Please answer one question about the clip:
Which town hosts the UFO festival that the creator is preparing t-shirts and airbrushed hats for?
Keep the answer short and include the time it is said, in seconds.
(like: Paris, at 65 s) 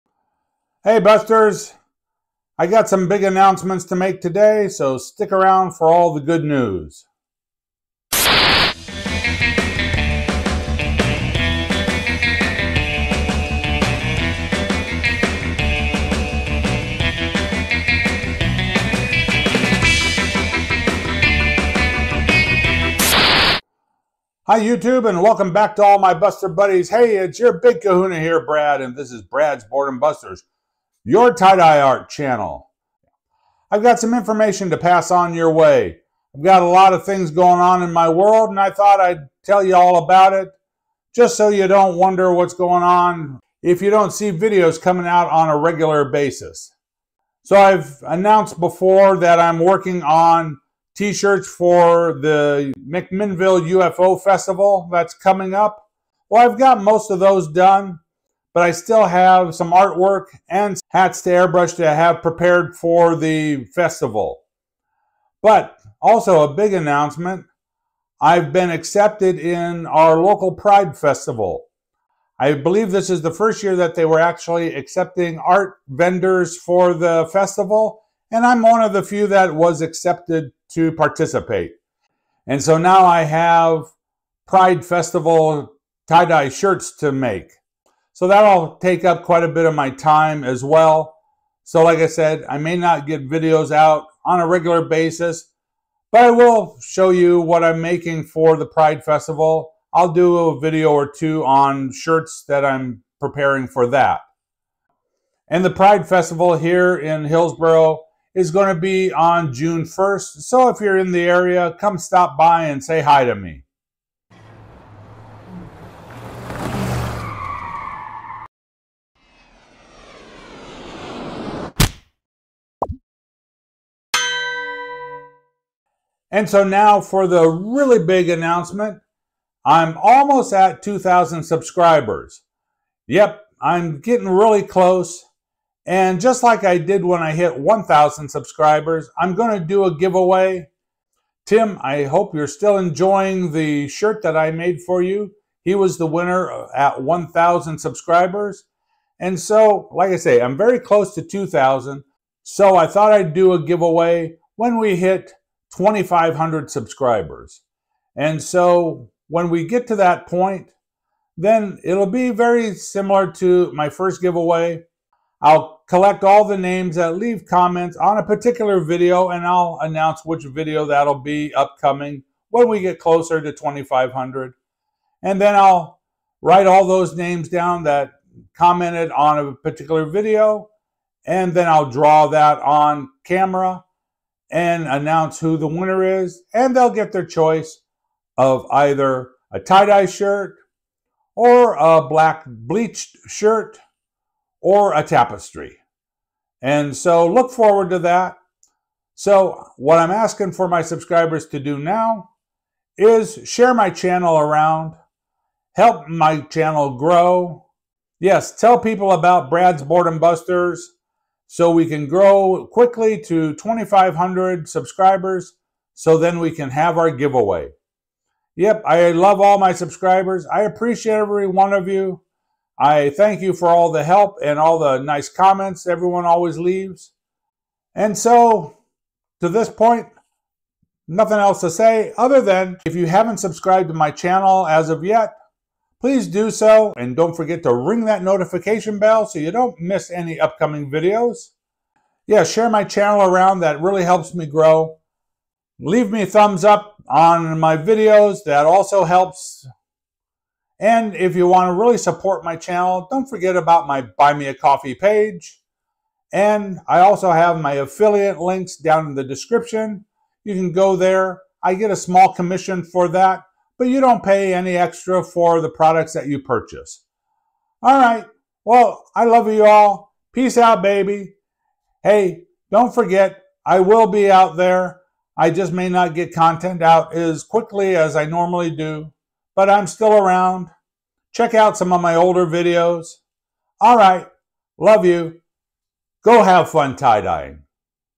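McMinnville, at 52 s.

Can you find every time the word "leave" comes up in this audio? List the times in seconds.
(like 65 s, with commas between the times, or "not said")
167 s, 226 s, 245 s.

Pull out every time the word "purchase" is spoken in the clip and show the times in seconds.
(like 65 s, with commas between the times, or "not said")
266 s.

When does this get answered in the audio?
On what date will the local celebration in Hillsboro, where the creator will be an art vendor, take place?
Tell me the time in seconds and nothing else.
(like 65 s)
109 s.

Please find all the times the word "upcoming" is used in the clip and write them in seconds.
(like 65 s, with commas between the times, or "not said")
171 s, 240 s.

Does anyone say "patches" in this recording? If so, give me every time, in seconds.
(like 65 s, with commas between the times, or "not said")
not said.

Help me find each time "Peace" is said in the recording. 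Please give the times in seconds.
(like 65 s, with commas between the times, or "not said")
270 s.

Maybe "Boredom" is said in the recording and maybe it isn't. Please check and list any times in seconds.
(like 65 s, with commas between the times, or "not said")
29 s, 209 s.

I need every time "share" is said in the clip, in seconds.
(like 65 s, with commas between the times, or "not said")
203 s, 242 s.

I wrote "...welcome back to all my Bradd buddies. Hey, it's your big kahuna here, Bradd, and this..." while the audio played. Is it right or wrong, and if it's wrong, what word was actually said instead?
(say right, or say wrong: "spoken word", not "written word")
wrong: "Buster", not "Bradd".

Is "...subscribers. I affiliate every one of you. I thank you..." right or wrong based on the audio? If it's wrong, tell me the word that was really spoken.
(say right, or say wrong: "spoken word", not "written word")
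wrong: "appreciate", not "affiliate".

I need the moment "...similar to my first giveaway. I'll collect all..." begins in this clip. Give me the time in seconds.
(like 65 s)
162 s.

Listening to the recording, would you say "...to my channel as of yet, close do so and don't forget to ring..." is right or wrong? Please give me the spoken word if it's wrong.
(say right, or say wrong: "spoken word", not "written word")
wrong: "please", not "close".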